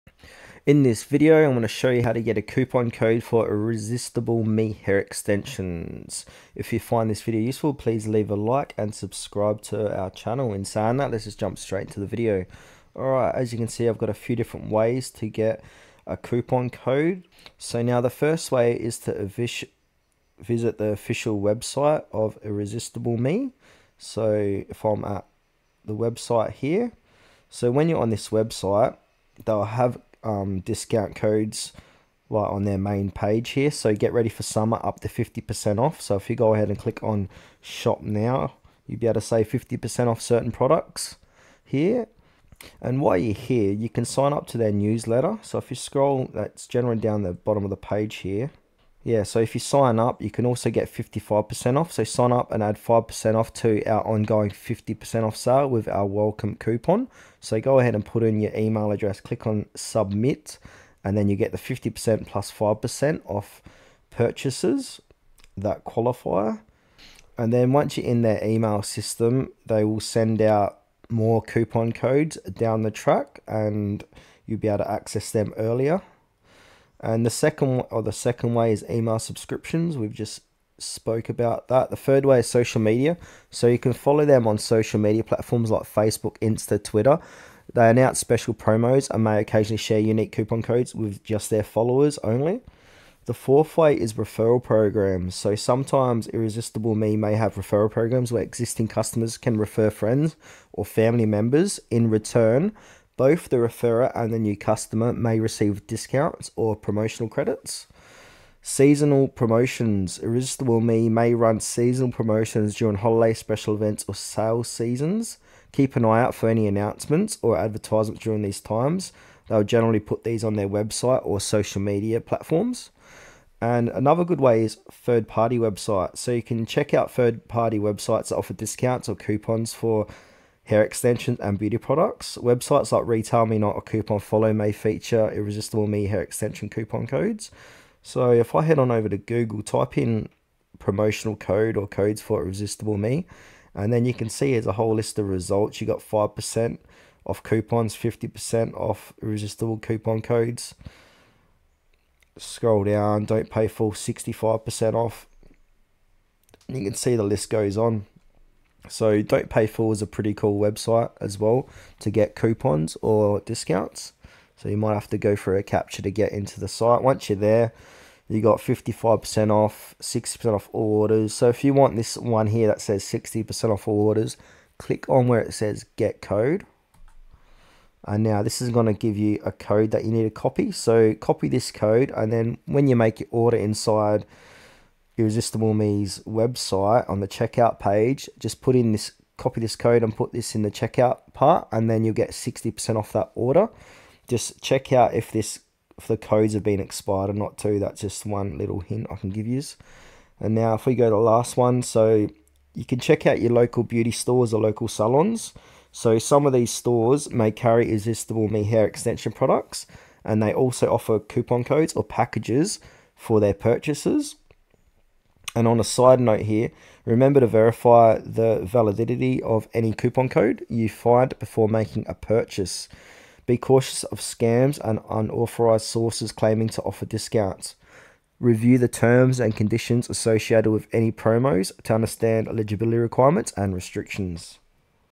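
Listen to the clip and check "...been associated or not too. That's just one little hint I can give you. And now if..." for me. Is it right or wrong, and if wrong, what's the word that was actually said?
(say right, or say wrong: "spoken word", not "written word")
wrong: "expired", not "associated".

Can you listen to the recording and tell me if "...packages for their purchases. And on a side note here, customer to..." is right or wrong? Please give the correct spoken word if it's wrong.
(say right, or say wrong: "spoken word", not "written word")
wrong: "remember", not "customer".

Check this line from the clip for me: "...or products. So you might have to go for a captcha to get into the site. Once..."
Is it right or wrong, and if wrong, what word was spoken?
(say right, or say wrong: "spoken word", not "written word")
wrong: "discounts", not "products".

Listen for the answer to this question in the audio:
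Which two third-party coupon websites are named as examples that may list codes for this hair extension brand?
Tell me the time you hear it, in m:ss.
2:13.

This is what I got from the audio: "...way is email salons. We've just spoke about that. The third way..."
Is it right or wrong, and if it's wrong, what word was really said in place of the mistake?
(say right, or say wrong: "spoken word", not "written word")
wrong: "subscriptions", not "salons".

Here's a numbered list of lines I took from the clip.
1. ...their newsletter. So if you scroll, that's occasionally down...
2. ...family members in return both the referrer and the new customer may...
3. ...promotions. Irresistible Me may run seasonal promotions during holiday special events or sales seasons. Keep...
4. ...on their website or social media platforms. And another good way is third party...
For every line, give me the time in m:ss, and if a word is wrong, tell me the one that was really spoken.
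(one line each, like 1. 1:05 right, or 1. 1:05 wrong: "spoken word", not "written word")
1. 0:44 wrong: "generally", not "occasionally"
2. 1:40 right
3. 1:49 right
4. 2:00 right.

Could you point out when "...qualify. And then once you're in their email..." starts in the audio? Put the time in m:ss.
1:05.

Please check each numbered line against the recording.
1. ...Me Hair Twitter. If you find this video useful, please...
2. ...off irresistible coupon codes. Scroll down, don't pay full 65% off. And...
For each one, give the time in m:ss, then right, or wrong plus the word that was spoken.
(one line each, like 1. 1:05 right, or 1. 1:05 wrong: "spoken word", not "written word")
1. 0:04 wrong: "Extensions", not "Twitter"
2. 2:28 right.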